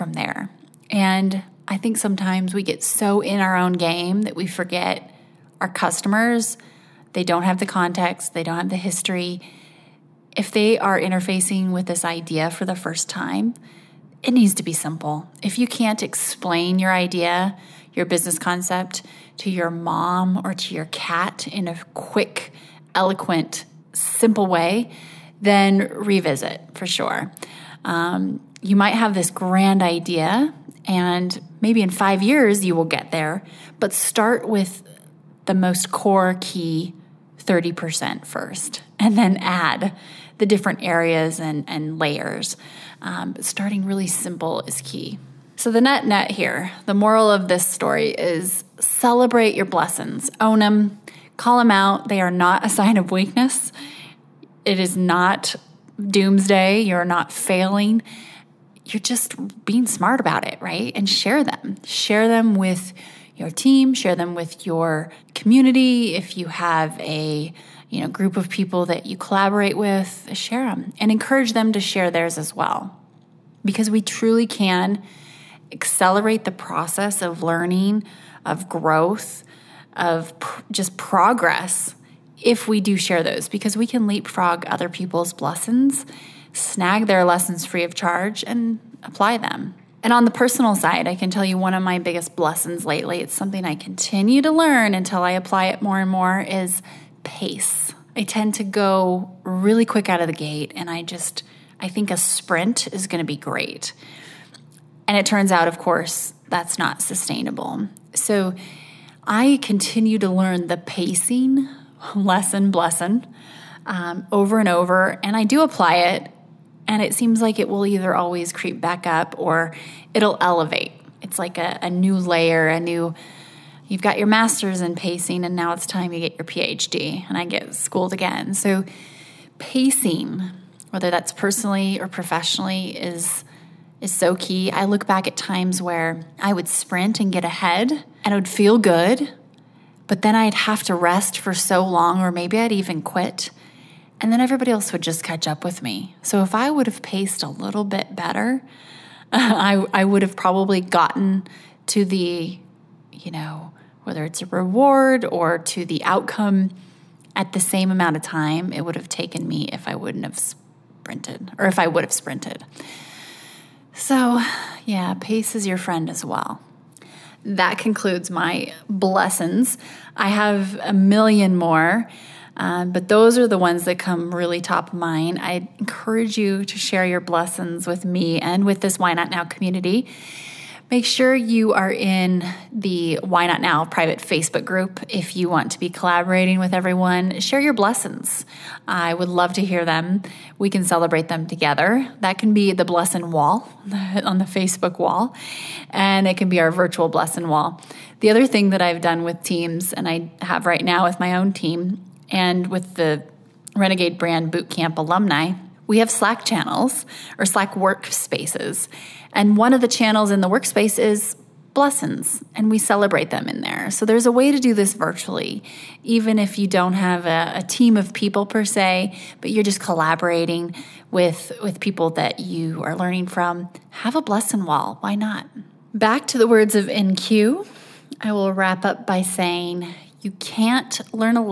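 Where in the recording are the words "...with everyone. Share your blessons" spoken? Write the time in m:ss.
3:06.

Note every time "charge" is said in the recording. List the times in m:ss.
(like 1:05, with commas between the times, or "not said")
1:27.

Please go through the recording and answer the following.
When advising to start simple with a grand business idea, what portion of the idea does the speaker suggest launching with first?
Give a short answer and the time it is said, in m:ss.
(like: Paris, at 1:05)
30%, at 0:37.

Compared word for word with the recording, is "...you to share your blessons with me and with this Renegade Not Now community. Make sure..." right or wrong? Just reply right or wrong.
wrong.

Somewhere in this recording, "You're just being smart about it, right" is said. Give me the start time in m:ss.
0:58.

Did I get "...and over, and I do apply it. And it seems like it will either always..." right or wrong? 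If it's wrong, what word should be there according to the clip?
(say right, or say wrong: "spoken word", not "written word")
right.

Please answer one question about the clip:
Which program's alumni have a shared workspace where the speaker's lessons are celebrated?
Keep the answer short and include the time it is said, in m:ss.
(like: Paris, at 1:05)
Renegade Brand Bootcamp, at 3:23.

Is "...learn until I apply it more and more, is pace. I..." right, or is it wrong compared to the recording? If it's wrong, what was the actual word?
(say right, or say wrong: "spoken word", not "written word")
right.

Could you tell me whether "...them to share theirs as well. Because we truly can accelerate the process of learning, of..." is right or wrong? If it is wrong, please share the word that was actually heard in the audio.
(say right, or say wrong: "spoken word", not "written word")
right.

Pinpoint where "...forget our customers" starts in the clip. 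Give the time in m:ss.
0:04.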